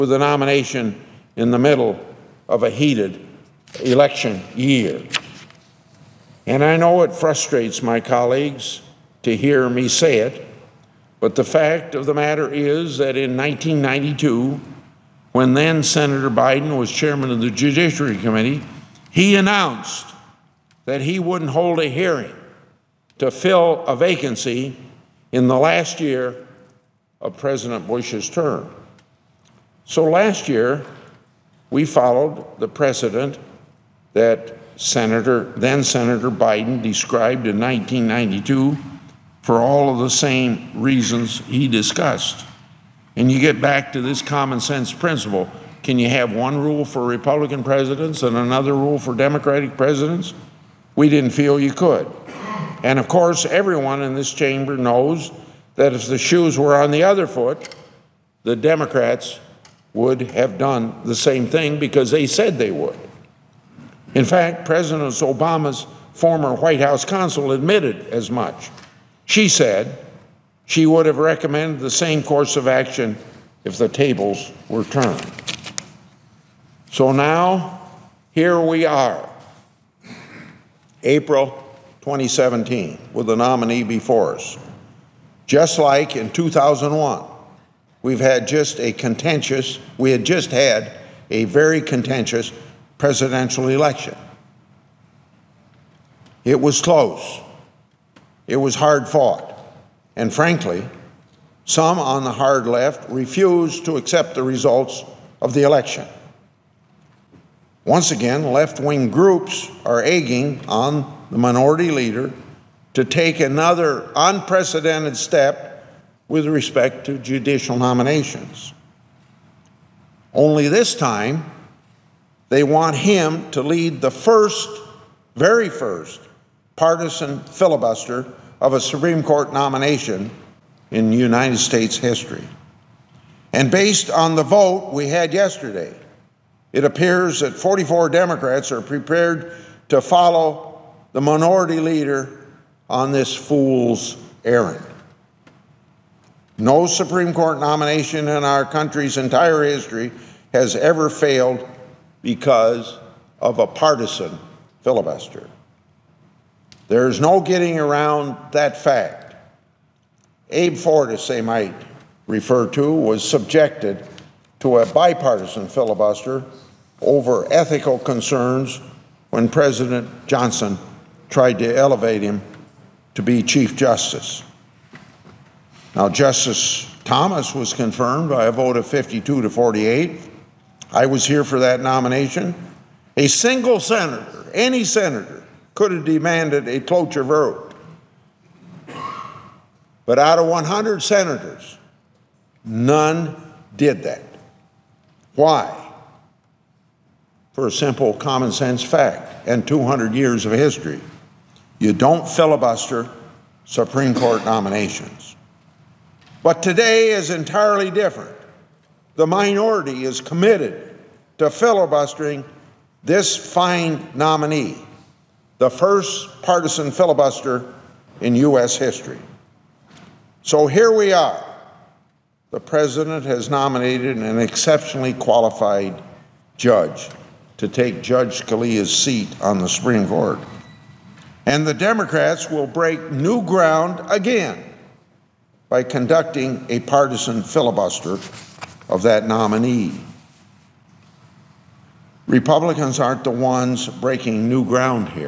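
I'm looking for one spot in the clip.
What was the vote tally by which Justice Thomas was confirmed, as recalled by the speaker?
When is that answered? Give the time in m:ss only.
2:58.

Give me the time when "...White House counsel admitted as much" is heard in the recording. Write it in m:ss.
1:06.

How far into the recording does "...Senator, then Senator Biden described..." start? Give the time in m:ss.
0:34.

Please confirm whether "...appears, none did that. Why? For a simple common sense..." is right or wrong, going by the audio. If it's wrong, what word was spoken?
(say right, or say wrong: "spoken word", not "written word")
wrong: "senators", not "appears".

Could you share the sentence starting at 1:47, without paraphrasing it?
Once again, left wing groups are egging on the minority leader, to take another unprecedented step with respect to judicial nominations.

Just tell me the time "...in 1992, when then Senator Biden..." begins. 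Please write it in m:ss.
0:13.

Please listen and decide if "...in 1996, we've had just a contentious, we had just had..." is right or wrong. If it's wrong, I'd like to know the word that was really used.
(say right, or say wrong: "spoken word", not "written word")
wrong: "2001", not "1996".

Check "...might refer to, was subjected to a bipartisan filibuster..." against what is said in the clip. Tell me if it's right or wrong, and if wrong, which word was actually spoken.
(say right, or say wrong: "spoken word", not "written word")
right.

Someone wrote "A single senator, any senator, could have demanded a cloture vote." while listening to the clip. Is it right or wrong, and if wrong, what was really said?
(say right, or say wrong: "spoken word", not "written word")
right.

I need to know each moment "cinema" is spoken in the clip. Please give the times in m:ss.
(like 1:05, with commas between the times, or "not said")
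not said.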